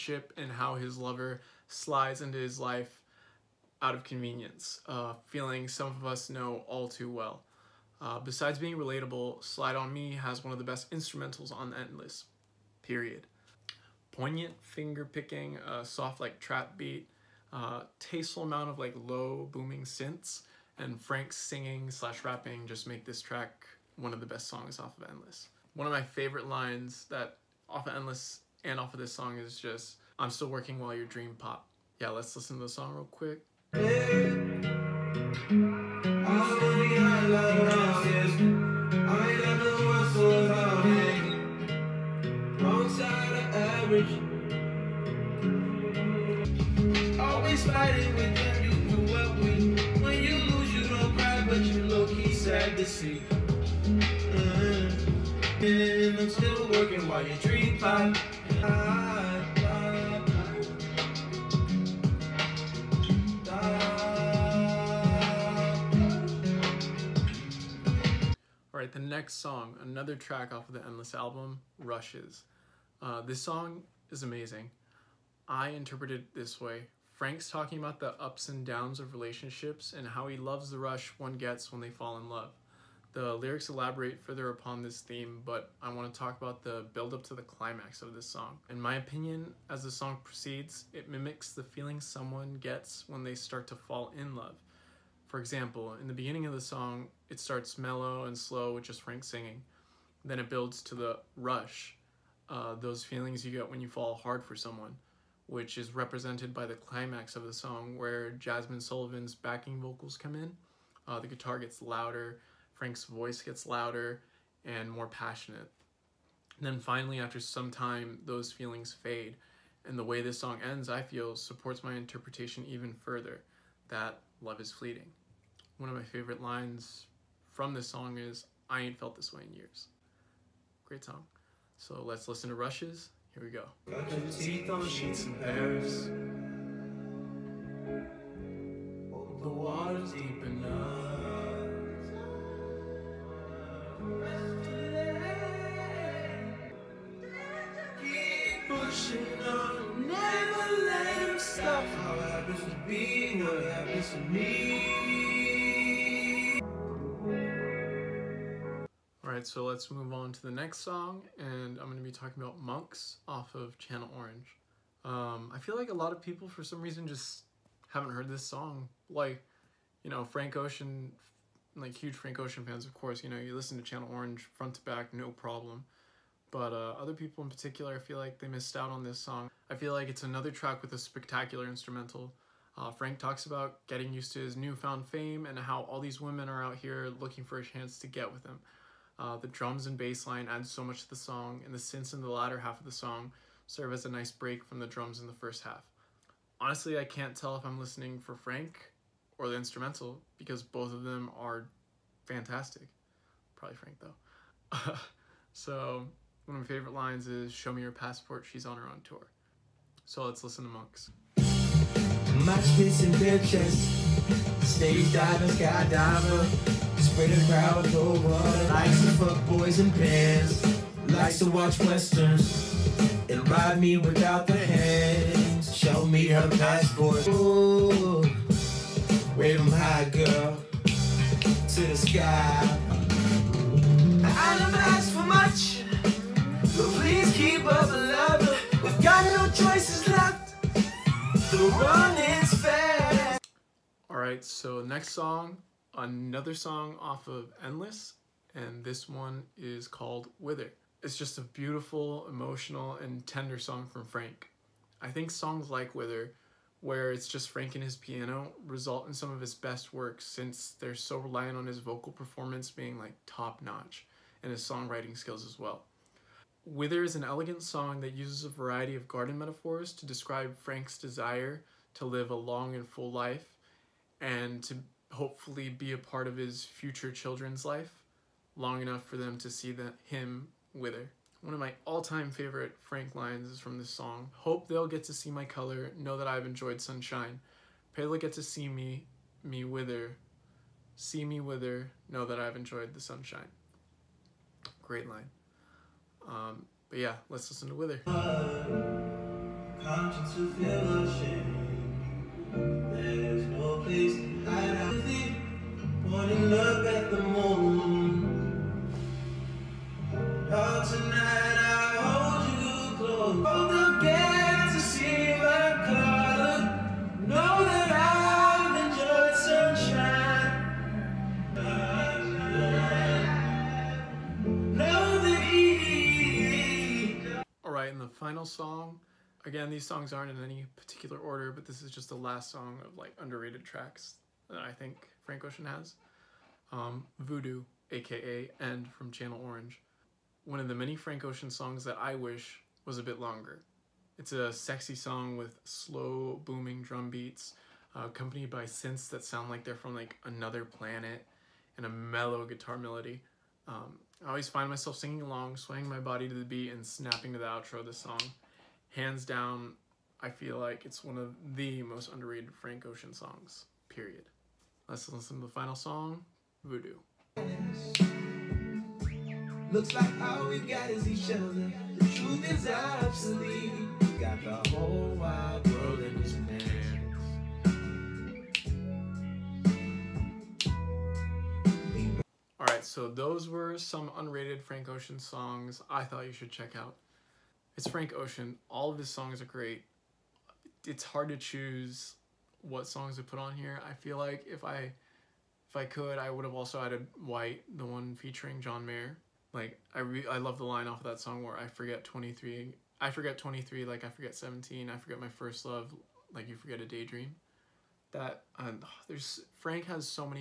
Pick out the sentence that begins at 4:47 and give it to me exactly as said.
Pray they'll get to see me, me wither.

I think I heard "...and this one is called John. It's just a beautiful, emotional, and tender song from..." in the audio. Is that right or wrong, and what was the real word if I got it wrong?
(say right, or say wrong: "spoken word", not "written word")
wrong: "Wither", not "John".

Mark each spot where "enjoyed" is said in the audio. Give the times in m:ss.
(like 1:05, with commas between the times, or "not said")
4:46, 4:52.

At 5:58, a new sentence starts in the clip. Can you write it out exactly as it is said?
Hands down, I feel like it's one of the most underrated Frank Ocean songs.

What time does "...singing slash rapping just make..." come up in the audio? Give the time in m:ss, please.
0:21.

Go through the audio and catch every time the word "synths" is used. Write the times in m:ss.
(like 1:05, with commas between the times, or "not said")
0:19, 3:11, 5:48.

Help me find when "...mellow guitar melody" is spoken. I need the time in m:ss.
5:51.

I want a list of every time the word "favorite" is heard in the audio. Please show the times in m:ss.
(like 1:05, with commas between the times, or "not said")
0:26, 2:06, 3:26, 4:42.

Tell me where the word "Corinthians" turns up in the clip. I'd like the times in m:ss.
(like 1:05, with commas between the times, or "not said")
not said.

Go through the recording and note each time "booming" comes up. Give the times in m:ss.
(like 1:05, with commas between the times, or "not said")
0:19, 5:46.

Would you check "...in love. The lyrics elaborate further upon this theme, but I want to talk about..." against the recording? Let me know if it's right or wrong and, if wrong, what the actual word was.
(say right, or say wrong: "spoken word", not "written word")
right.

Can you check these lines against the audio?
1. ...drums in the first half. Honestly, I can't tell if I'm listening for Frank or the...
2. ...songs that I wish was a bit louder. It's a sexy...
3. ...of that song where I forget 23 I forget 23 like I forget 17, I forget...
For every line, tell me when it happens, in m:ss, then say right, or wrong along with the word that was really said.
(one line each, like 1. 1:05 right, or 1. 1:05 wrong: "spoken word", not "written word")
1. 3:14 right
2. 5:41 wrong: "longer", not "louder"
3. 6:40 right.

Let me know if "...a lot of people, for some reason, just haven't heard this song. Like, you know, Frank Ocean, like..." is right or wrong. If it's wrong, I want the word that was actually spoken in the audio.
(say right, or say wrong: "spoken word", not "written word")
right.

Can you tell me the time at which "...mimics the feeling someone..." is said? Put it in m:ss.
1:31.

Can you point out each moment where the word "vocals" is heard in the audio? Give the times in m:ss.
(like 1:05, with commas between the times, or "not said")
1:49, 4:21.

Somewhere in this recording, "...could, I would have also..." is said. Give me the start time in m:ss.
6:35.